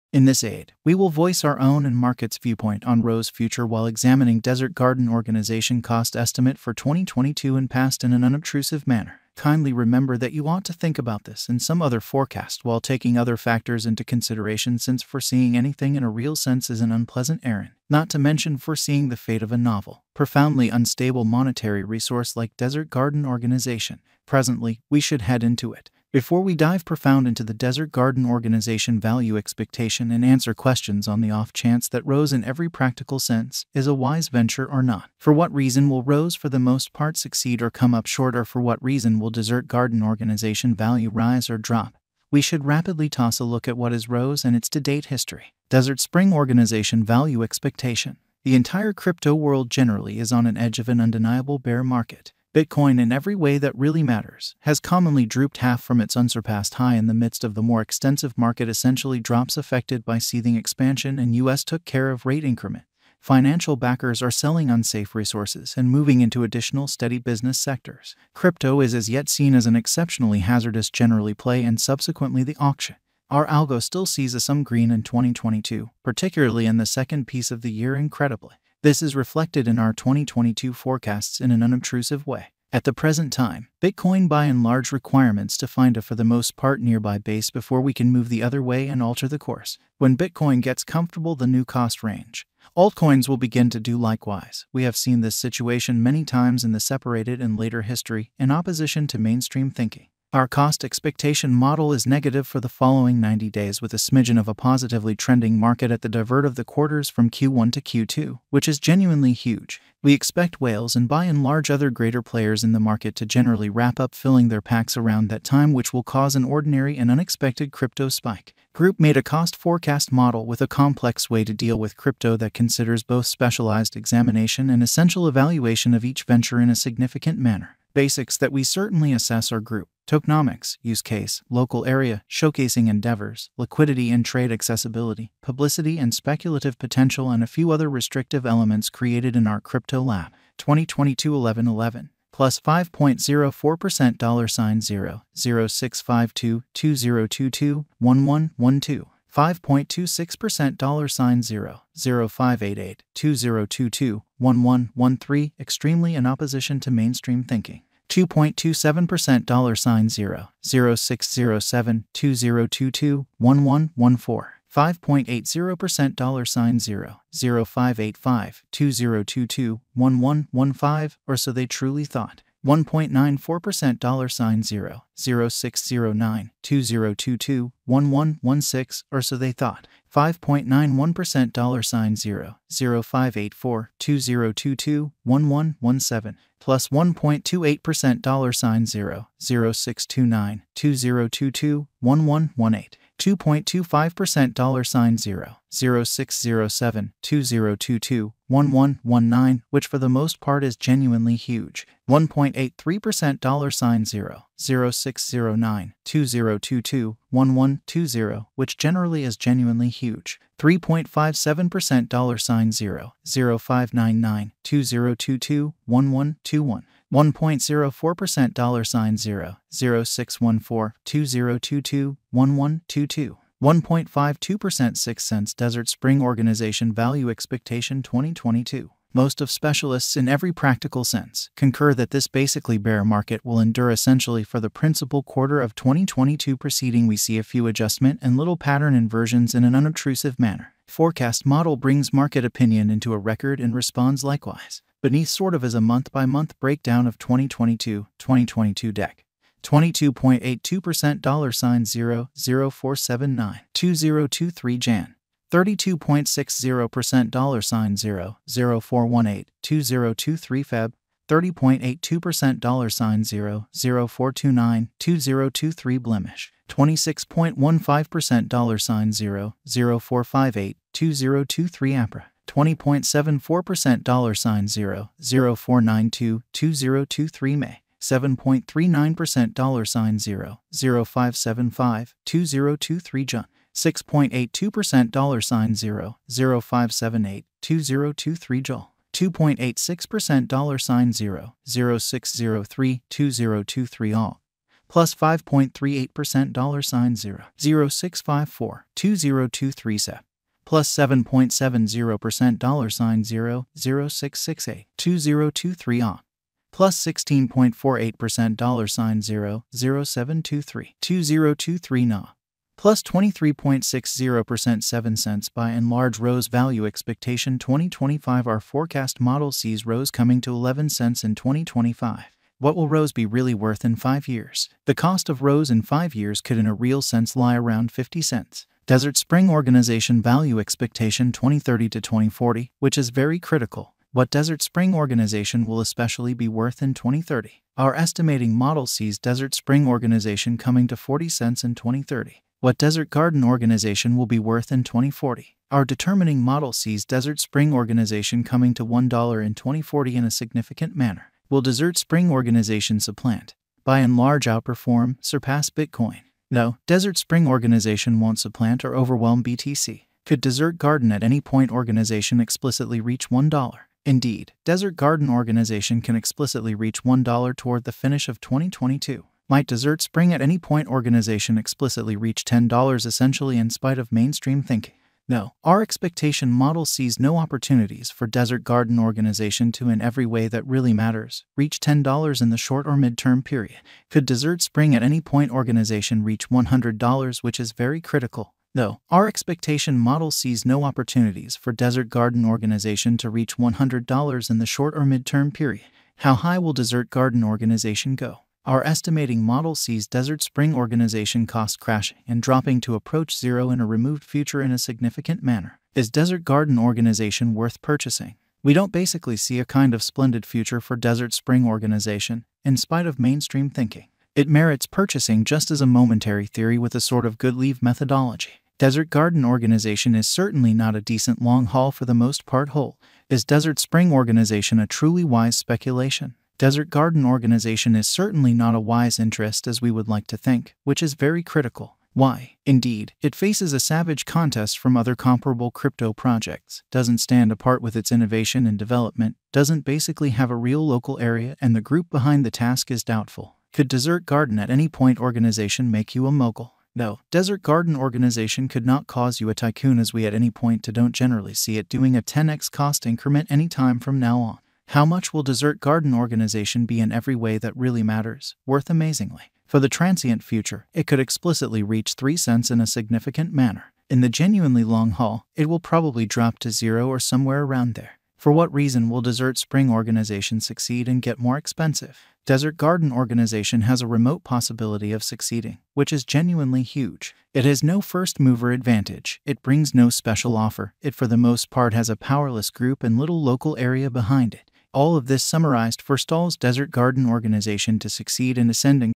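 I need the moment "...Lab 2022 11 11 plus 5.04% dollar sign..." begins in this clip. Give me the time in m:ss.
2:20.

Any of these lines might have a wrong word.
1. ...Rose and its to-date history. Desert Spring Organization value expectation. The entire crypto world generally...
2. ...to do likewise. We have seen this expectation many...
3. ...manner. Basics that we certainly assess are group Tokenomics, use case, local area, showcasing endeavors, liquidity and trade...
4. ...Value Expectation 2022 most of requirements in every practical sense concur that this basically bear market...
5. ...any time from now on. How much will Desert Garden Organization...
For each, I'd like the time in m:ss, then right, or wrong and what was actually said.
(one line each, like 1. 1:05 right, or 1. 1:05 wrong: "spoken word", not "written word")
1. 0:44 right
2. 1:33 wrong: "situation", not "expectation"
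3. 2:07 right
4. 3:46 wrong: "specialists", not "requirements"
5. 7:33 right.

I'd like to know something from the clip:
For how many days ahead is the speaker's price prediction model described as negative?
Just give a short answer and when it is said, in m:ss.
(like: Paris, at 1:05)
90 days, at 1:43.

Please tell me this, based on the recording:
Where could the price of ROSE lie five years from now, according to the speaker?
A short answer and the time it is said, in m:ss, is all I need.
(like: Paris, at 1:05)
50 cents, at 5:27.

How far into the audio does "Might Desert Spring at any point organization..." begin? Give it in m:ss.
6:09.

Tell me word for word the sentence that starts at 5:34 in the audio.
What Desert Spring Organization will especially be worth in 2030?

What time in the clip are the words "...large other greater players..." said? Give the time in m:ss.
1:51.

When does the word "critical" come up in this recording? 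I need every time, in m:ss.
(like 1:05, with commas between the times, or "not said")
5:33, 6:28, 7:11.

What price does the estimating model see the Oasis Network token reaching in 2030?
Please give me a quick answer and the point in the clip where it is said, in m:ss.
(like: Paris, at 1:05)
40 cents, at 5:40.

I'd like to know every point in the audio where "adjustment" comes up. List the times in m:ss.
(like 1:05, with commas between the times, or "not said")
3:57.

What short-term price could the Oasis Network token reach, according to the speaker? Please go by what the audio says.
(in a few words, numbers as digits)
3 cents.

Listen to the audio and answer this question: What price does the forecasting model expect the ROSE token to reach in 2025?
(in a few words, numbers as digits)
11 cents.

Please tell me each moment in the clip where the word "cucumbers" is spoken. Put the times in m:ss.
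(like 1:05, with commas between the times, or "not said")
not said.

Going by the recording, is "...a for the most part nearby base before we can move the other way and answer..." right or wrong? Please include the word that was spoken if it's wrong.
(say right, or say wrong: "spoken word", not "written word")
wrong: "alter", not "answer".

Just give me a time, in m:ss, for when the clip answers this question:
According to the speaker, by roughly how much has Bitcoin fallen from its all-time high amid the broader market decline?
0:55.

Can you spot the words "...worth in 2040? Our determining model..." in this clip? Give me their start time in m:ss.
5:44.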